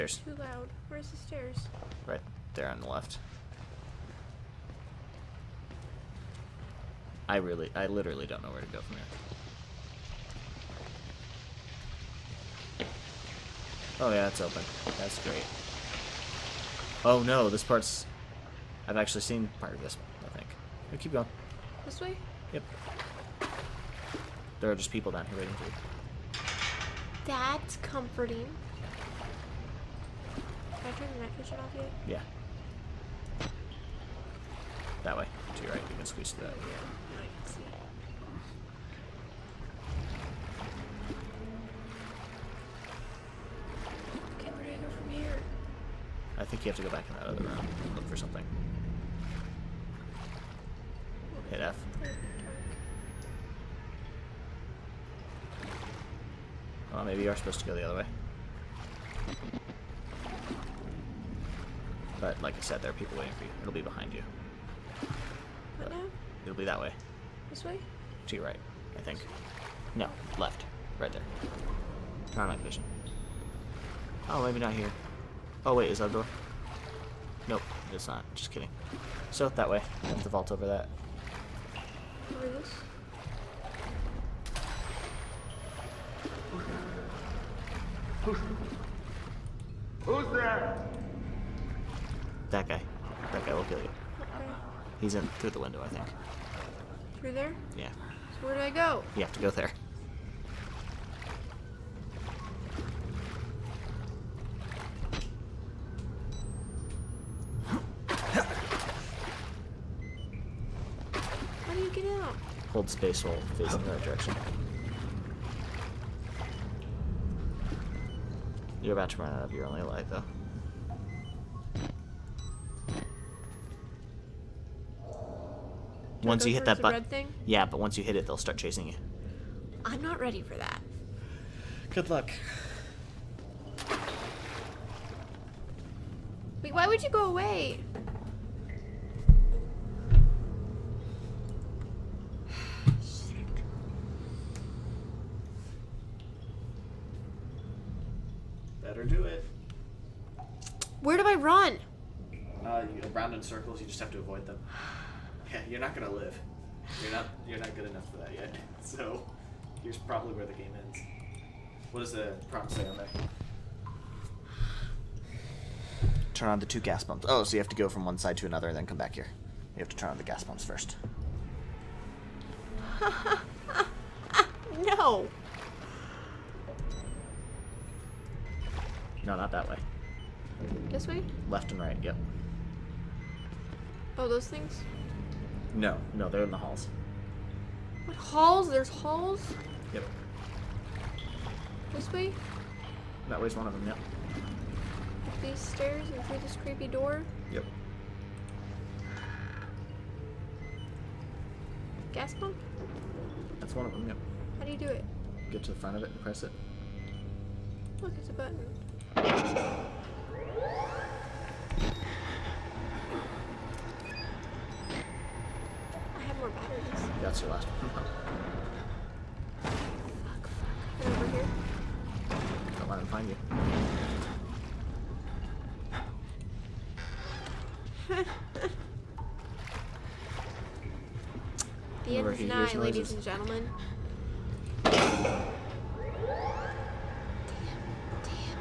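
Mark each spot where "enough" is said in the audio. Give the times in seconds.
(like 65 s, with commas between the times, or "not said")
157 s.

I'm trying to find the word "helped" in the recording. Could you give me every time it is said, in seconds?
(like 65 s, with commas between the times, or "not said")
not said.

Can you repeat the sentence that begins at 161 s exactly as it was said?
What does the prompt say on there?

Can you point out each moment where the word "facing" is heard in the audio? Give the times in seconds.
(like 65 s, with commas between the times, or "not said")
113 s.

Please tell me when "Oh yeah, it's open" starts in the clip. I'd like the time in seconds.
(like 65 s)
13 s.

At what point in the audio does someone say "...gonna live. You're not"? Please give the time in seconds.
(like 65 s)
155 s.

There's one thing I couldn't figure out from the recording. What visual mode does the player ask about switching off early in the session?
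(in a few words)
night vision.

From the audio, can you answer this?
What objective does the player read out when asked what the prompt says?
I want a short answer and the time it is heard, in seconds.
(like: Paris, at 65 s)
Turn on the two gas pumps, at 166 s.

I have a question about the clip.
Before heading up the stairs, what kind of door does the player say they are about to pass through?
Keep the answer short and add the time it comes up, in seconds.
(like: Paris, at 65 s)
creepy door, at 196 s.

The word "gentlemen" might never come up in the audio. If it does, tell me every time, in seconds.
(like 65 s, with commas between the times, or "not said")
233 s.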